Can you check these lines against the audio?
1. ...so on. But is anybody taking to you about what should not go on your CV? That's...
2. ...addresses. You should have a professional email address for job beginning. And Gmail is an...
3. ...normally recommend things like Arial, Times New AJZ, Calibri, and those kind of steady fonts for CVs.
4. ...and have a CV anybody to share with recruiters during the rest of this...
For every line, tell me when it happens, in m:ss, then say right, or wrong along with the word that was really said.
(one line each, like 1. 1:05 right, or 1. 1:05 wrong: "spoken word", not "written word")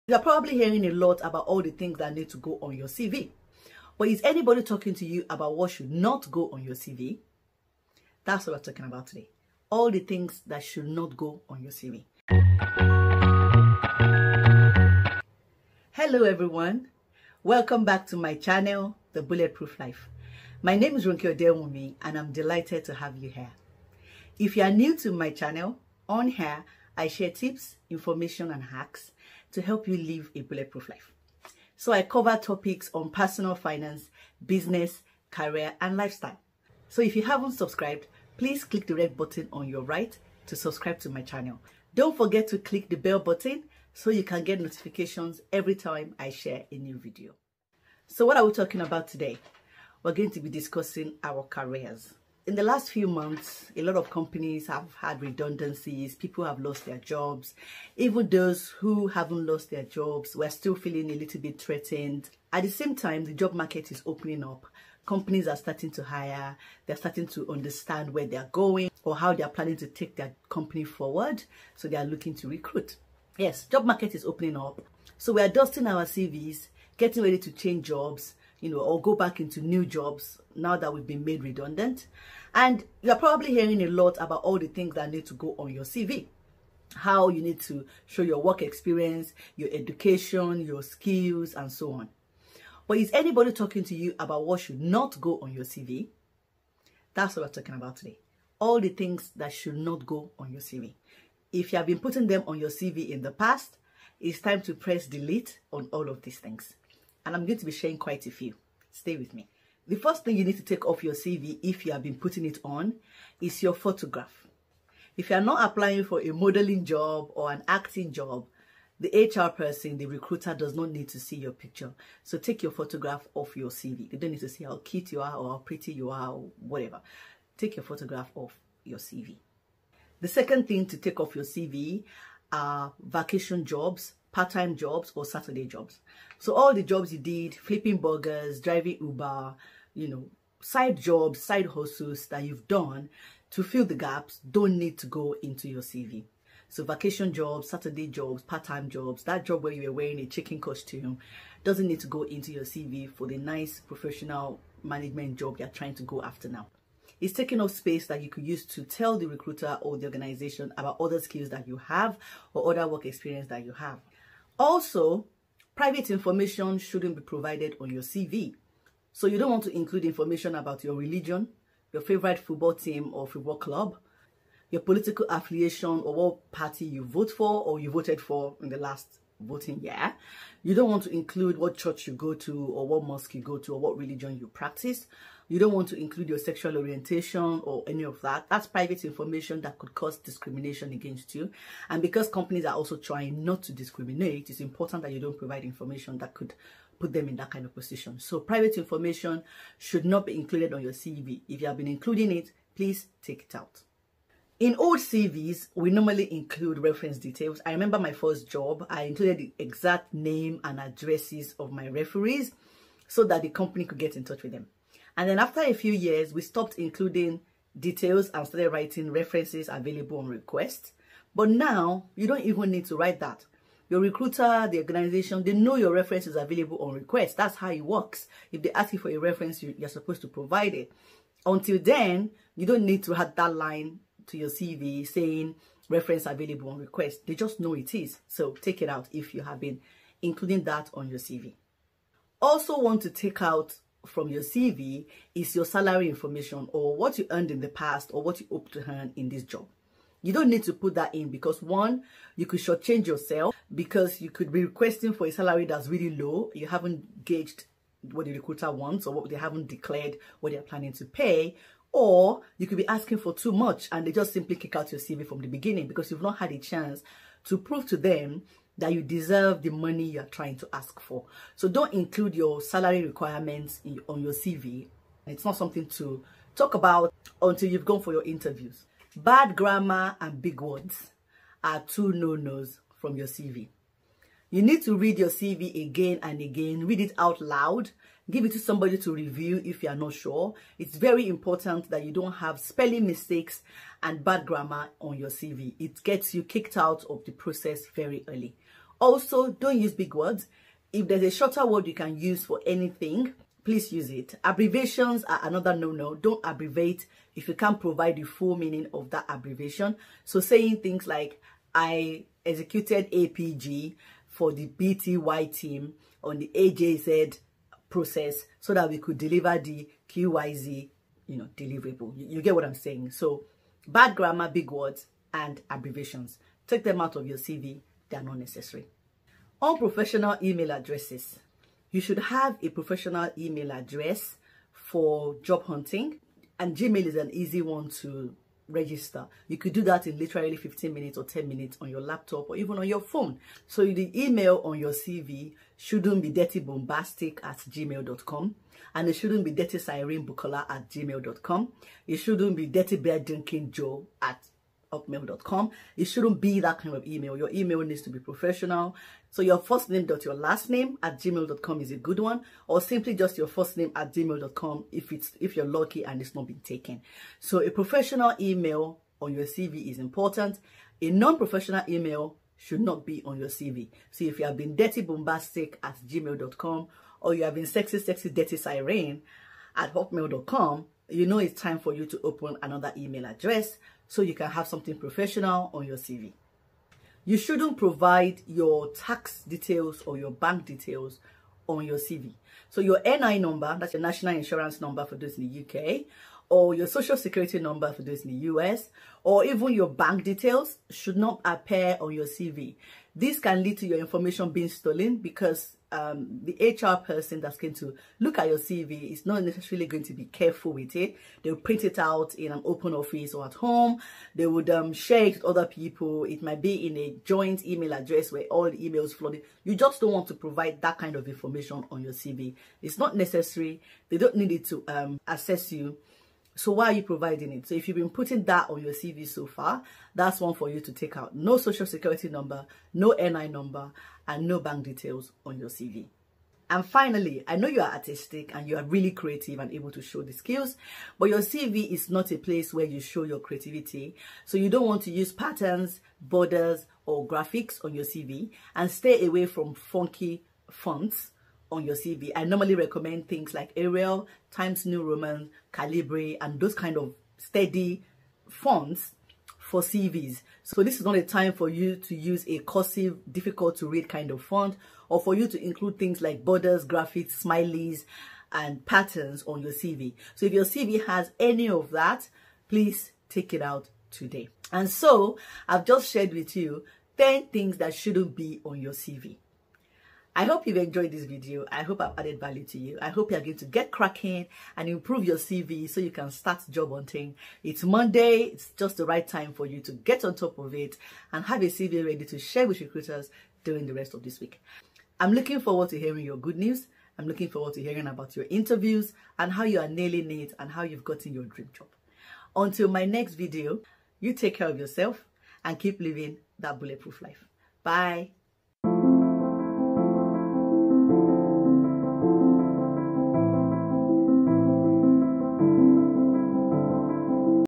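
1. 1:31 wrong: "talking", not "taking"
2. 5:30 wrong: "hunting", not "beginning"
3. 7:32 wrong: "Roman", not "AJZ"
4. 8:11 wrong: "ready", not "anybody".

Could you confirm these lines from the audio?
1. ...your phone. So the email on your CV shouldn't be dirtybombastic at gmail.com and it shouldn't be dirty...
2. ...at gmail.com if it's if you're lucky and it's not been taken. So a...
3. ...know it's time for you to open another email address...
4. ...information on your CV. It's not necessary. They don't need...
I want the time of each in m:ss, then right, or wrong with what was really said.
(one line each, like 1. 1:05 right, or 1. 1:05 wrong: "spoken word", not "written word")
1. 5:42 right
2. 6:03 right
3. 6:21 right
4. 7:01 right.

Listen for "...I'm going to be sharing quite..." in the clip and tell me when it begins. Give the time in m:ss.
1:47.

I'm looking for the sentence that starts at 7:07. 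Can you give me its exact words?
So if you've been putting that on your CV so far, that's one for you to take out.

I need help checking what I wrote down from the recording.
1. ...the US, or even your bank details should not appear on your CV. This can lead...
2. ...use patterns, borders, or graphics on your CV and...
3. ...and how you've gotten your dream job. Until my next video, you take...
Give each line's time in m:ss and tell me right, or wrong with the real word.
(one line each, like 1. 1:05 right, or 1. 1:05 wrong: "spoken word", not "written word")
1. 6:38 right
2. 7:25 right
3. 8:20 right.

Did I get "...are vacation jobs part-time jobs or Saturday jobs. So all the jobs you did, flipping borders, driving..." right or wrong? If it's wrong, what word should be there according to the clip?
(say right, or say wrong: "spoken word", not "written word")
wrong: "burgers", not "borders".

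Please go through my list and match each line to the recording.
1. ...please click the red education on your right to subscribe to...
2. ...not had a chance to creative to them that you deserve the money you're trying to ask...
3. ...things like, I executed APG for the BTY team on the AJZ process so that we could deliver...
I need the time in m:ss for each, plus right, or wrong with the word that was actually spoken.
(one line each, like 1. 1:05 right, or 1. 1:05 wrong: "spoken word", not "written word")
1. 0:38 wrong: "button", not "education"
2. 4:26 wrong: "prove", not "creative"
3. 5:10 right.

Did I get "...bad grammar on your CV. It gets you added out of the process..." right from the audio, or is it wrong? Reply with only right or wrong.
wrong.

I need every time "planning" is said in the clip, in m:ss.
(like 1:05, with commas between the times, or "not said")
1:09, 4:20.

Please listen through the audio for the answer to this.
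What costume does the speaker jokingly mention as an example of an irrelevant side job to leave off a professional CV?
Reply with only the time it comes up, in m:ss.
2:30.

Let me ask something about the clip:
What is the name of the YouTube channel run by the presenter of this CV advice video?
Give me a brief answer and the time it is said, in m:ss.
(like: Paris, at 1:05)
The Bulletproof Life, at 0:19.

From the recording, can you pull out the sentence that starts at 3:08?
That's private information that could cause discrimination against you.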